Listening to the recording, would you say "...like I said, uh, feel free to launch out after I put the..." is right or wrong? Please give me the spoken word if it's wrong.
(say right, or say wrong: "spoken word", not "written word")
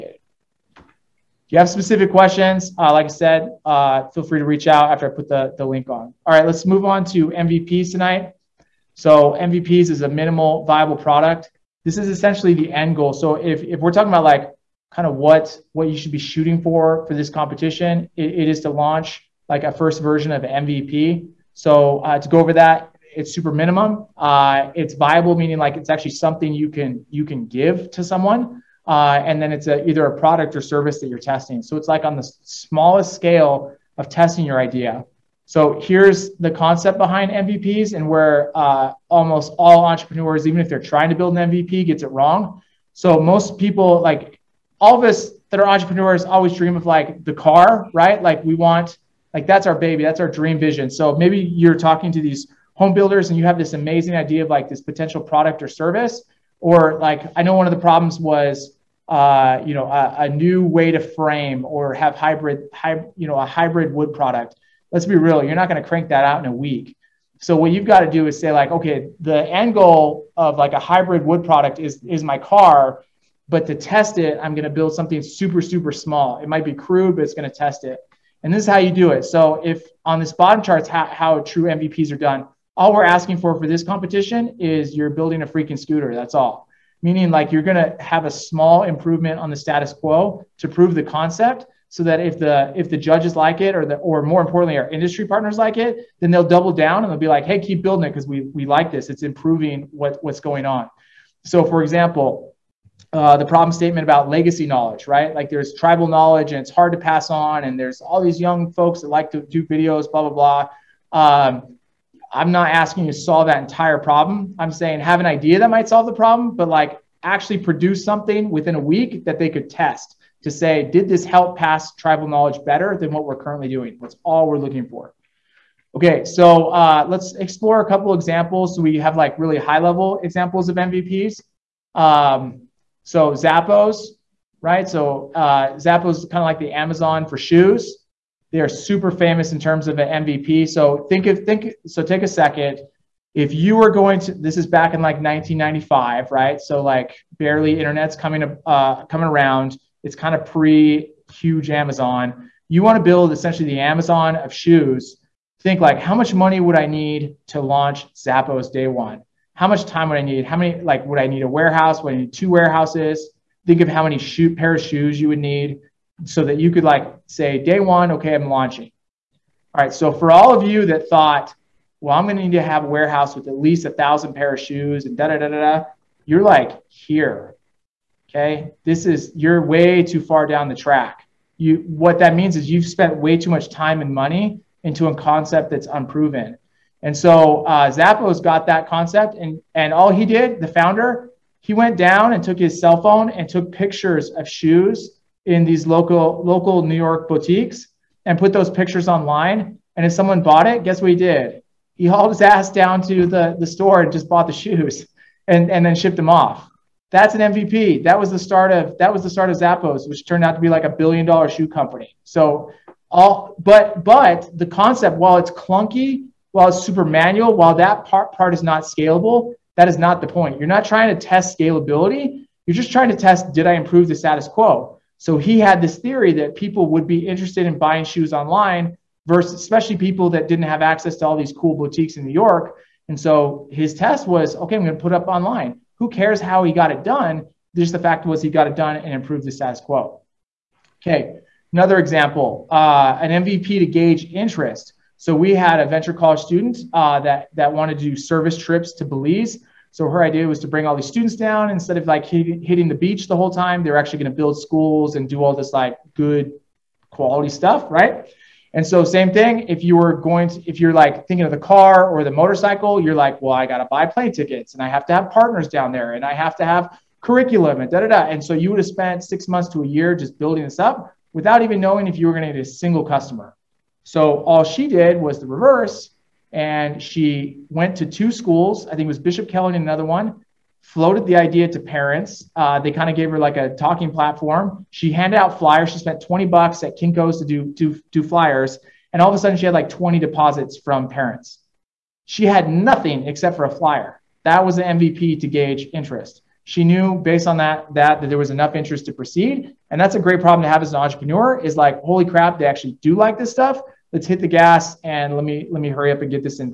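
wrong: "reach", not "launch".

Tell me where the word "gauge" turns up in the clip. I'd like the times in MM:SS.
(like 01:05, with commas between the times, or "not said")
04:03, 04:55.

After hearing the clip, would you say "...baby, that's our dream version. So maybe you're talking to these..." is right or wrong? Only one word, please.
wrong.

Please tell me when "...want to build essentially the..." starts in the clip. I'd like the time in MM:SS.
02:32.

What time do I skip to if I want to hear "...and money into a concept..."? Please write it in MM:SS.
03:04.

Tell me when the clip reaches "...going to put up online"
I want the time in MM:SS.
03:54.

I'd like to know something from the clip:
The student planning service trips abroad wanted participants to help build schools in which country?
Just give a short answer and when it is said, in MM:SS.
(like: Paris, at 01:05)
Belize, at 04:09.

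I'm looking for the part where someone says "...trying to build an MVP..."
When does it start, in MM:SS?
00:40.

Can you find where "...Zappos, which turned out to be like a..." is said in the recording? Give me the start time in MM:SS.
03:29.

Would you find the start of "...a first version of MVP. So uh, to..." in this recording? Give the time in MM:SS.
00:19.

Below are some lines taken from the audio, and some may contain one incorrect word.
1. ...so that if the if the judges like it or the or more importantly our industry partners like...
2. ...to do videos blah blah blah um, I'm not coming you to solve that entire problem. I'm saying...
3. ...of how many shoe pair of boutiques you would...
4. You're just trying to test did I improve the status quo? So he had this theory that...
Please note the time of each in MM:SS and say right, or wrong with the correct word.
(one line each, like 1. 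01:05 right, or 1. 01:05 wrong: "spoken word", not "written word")
1. 01:31 right
2. 01:49 wrong: "asking", not "coming"
3. 02:43 wrong: "shoes", not "boutiques"
4. 03:42 right.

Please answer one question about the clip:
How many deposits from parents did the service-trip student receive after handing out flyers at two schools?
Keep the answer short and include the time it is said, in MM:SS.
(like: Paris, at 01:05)
20, at 04:49.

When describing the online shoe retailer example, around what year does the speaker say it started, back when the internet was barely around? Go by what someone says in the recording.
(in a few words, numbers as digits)
1995.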